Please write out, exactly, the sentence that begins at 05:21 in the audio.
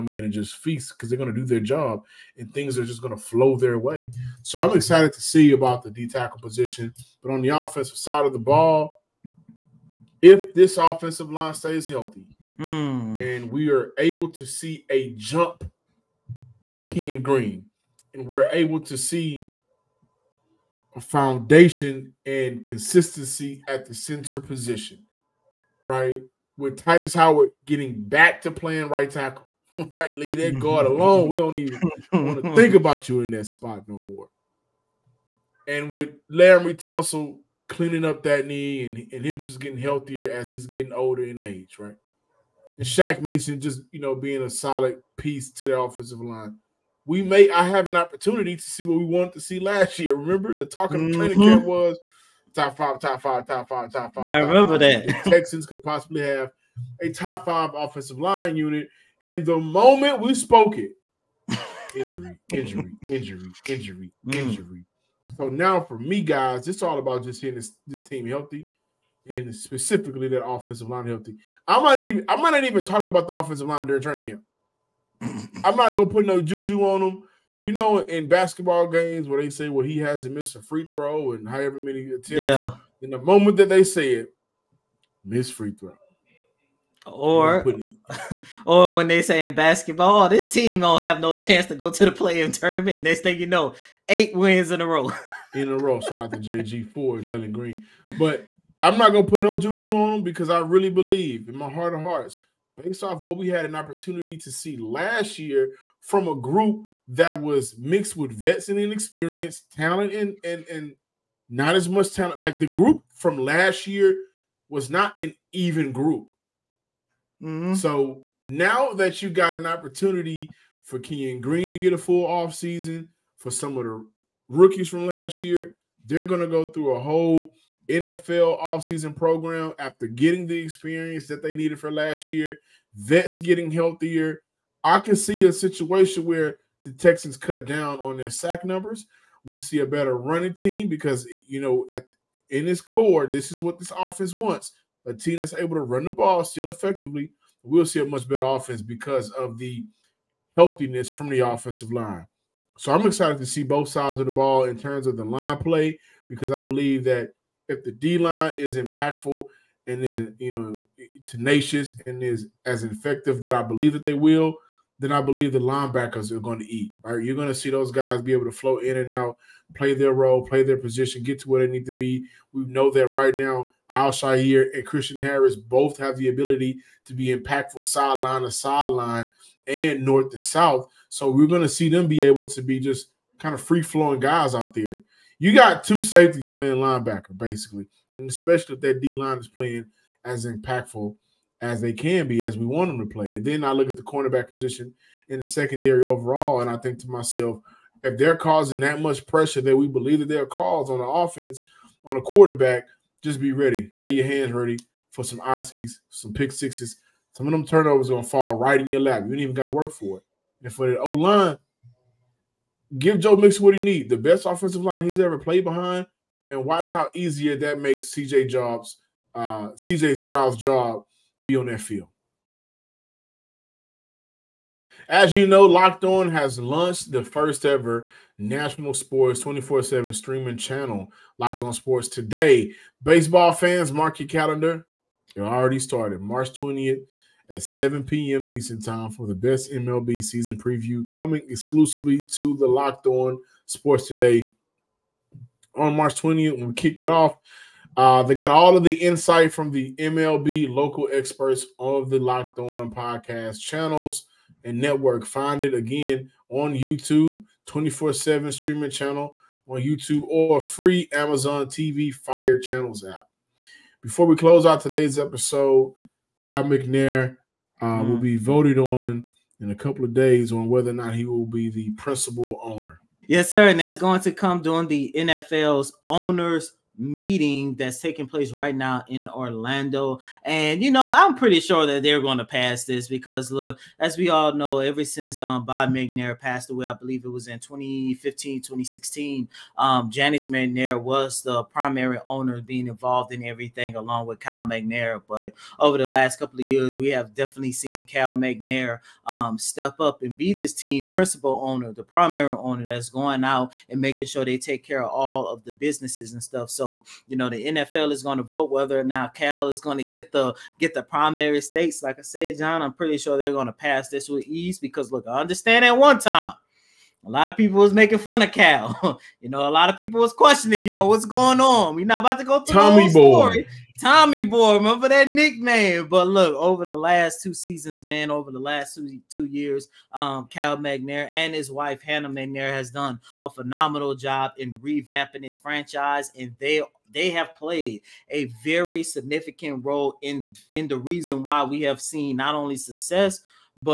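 We're not about to go through Tommy Boy.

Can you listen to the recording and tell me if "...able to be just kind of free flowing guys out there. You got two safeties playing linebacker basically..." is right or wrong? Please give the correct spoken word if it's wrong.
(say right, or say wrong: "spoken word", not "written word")
right.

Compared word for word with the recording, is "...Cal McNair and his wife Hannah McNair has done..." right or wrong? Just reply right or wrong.
right.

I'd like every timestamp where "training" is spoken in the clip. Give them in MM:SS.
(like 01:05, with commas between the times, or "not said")
00:51, 01:14.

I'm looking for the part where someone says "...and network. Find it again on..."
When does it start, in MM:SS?
04:14.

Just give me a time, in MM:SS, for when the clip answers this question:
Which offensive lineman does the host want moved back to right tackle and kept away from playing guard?
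00:26.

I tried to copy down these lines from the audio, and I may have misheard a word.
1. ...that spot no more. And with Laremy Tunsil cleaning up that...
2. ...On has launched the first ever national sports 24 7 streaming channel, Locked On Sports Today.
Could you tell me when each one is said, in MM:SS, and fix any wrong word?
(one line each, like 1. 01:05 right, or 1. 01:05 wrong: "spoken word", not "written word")
1. 00:33 right
2. 03:46 right.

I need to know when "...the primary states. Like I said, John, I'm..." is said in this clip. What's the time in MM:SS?
05:10.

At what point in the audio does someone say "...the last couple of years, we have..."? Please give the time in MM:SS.
04:55.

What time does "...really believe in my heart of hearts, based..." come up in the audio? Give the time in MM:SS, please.
01:40.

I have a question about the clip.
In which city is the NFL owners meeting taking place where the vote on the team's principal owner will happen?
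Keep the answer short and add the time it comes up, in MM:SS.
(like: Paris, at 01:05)
Orlando, at 04:39.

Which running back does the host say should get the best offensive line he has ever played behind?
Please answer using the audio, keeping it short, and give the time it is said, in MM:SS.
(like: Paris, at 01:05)
Joe Mixon, at 03:33.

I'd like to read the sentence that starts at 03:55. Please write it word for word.
It already started March 20th at 7 p.m.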